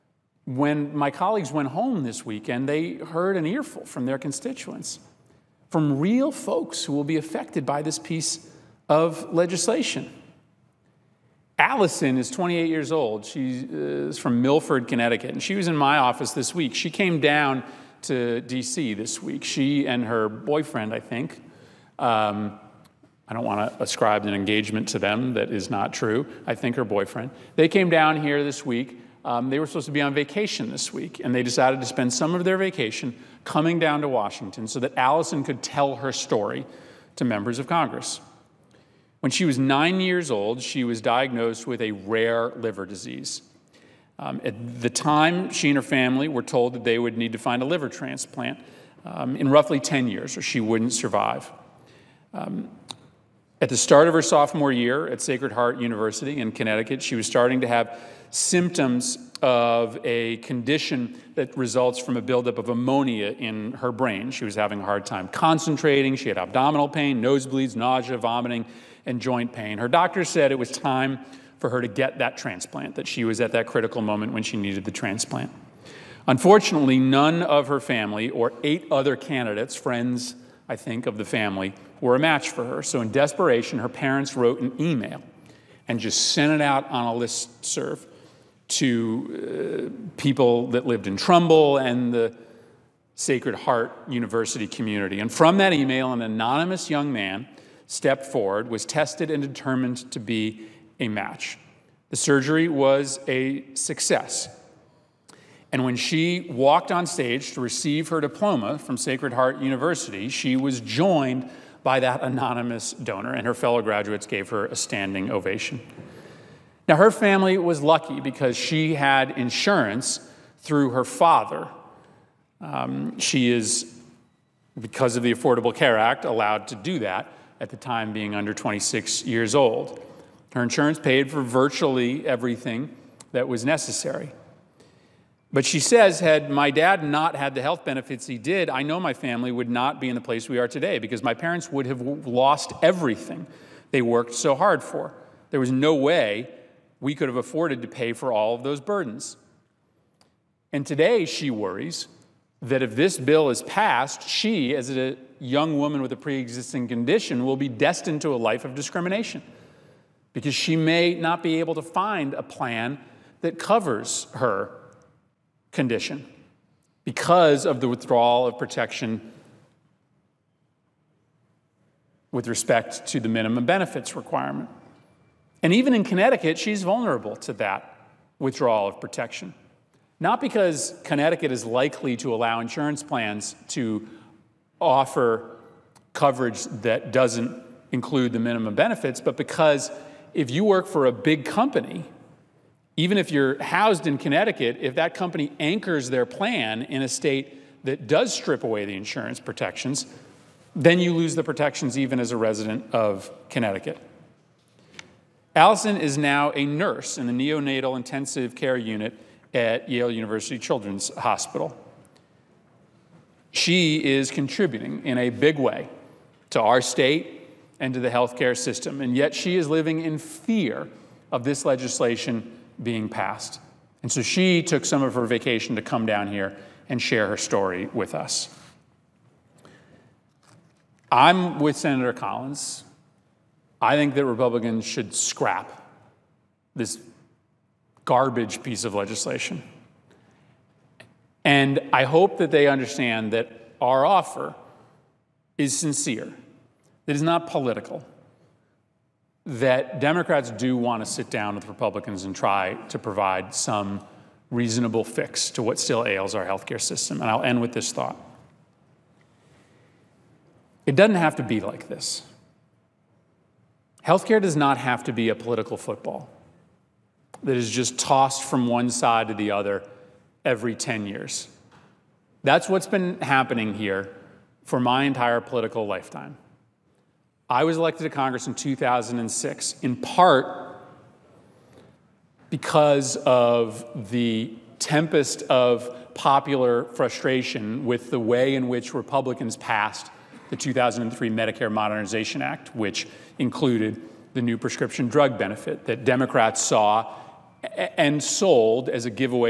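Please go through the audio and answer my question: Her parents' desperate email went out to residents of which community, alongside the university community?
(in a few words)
Trumbull.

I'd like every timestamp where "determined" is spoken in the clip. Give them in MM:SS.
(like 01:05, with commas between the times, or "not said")
01:39.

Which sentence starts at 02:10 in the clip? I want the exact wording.
Her insurance paid for virtually everything that was necessary.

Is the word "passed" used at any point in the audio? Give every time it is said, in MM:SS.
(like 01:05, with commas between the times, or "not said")
02:33, 03:43, 04:49.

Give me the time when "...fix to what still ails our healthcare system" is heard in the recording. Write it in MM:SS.
04:15.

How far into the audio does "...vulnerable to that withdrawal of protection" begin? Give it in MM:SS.
02:56.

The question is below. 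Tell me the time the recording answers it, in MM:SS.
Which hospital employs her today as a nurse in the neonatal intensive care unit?
03:29.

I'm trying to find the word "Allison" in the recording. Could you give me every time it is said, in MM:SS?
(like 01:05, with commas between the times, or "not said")
00:11, 00:34, 03:25.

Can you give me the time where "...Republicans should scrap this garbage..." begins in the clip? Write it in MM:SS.
03:54.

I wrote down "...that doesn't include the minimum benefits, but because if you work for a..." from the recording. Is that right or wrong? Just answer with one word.
right.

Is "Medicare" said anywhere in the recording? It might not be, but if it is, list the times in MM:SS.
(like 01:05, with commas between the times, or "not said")
04:51.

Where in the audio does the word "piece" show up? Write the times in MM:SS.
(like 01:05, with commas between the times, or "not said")
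00:07, 03:58.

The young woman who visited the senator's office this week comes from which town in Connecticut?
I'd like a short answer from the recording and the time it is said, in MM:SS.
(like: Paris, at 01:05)
Milford, at 00:14.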